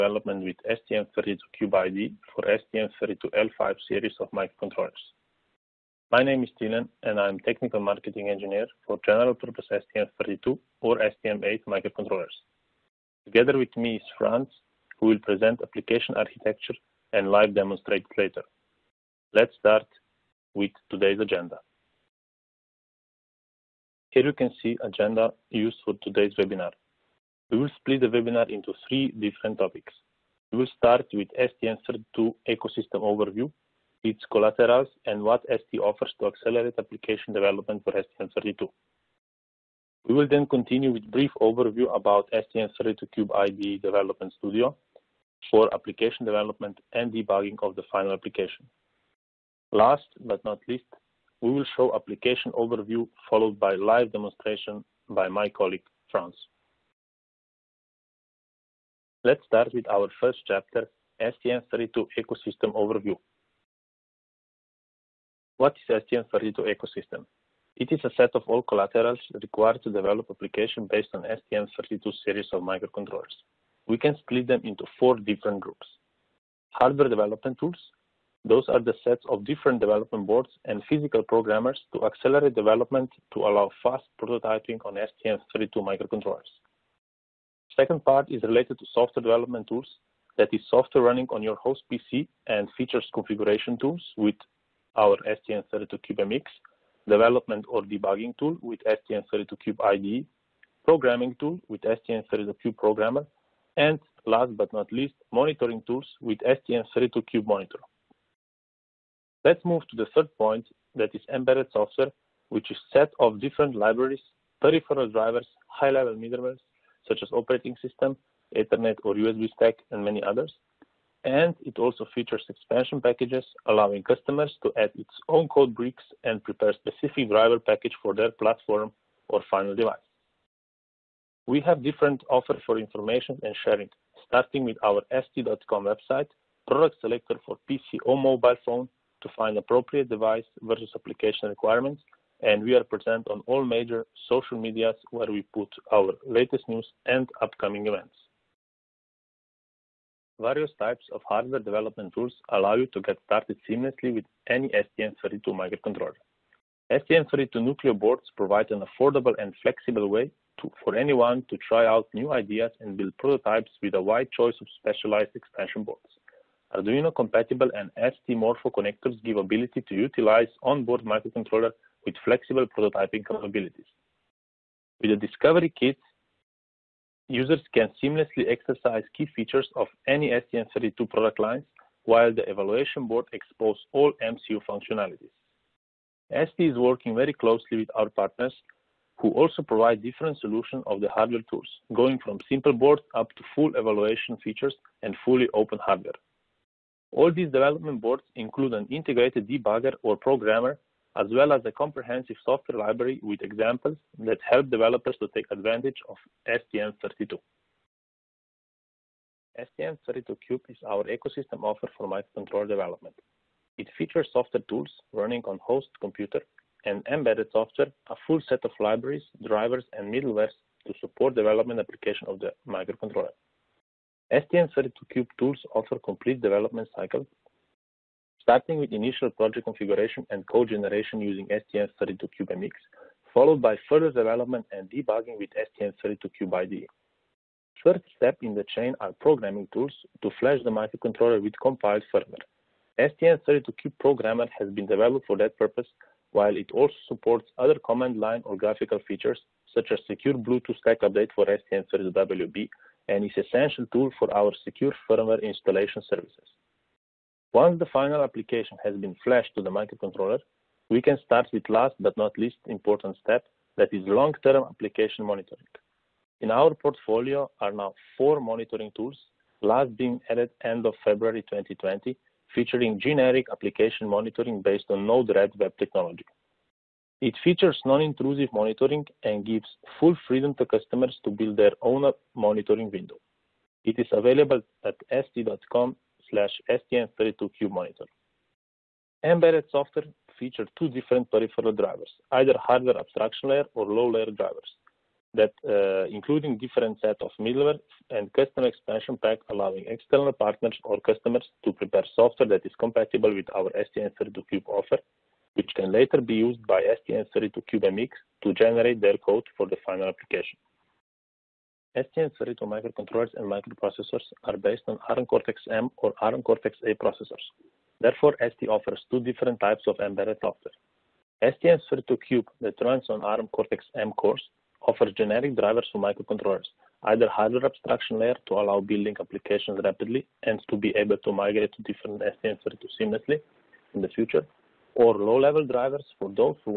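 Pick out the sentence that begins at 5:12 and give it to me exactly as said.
STM32 microcontrollers and microprocessors are based on ARM Cortex-M or ARM Cortex-A processors.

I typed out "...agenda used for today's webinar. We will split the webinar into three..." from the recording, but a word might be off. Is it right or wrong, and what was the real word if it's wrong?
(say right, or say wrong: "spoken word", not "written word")
right.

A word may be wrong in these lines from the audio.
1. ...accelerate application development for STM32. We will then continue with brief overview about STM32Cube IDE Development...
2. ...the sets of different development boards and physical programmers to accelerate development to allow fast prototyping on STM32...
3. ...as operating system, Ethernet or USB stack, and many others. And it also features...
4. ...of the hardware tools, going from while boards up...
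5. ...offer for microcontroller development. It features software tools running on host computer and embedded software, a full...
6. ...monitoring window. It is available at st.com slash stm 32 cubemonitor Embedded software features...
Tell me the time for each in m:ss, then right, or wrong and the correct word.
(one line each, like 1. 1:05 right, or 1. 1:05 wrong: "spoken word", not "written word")
1. 0:36 right
2. 1:18 right
3. 1:57 right
4. 3:10 wrong: "simple", not "while"
5. 3:31 right
6. 4:42 right.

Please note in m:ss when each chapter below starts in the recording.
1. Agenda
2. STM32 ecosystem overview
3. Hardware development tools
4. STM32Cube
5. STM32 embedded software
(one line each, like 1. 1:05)
1. 0:24
2. 0:58
3. 2:29
4. 3:28
5. 5:10.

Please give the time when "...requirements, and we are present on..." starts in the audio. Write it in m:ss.
2:21.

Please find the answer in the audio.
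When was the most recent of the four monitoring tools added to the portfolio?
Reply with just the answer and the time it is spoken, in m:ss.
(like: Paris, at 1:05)
End of February 2020, at 4:30.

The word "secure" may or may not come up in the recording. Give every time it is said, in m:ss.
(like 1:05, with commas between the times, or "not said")
4:10, 4:14.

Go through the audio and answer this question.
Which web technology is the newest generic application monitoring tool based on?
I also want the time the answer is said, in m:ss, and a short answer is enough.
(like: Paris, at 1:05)
Node-RED, at 4:35.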